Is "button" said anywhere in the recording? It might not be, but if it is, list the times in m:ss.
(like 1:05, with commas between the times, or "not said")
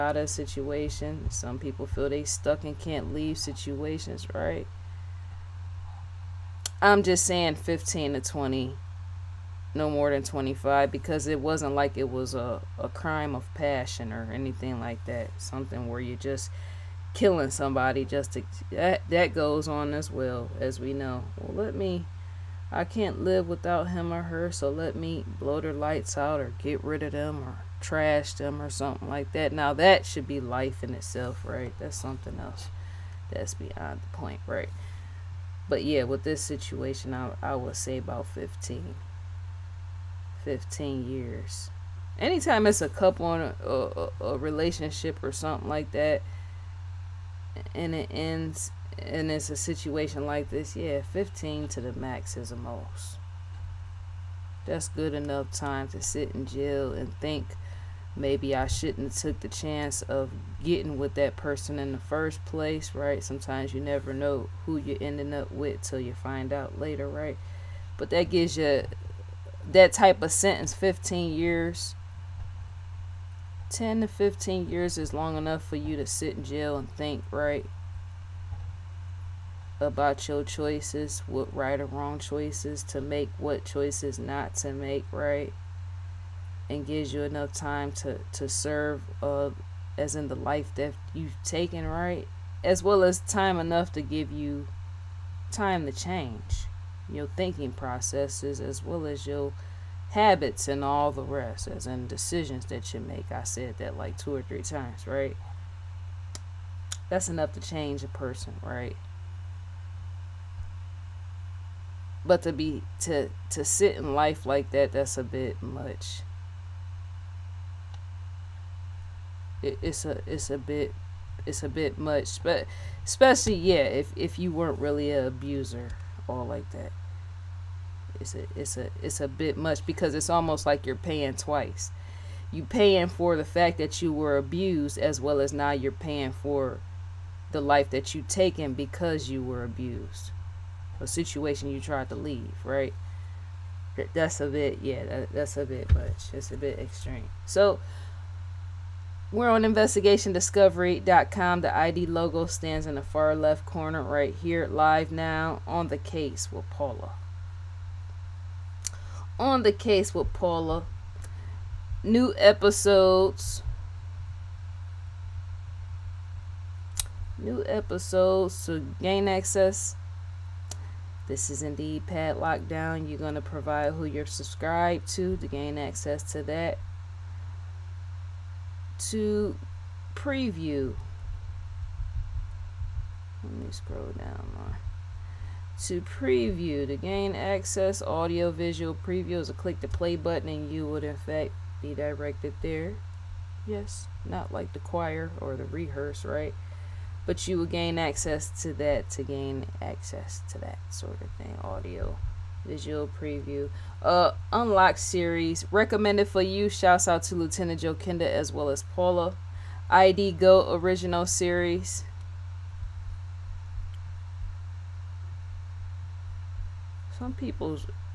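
3:10.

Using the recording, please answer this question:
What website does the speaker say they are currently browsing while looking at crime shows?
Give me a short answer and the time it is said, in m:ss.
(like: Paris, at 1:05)
investigationdiscovery.com, at 2:29.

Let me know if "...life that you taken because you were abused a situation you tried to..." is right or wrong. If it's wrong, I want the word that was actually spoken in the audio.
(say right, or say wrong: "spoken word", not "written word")
right.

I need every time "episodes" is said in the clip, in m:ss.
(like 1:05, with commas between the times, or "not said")
2:42, 2:47.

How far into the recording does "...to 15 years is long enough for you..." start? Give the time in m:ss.
1:14.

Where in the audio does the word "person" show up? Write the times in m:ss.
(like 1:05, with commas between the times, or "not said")
1:01, 1:48.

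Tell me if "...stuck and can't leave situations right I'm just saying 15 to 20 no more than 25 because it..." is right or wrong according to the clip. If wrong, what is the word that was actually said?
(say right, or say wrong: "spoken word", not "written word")
right.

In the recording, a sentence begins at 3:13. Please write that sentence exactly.
Yes, not like the choir or the rehearse, right?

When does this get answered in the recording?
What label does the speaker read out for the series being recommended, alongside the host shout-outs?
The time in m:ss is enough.
3:29.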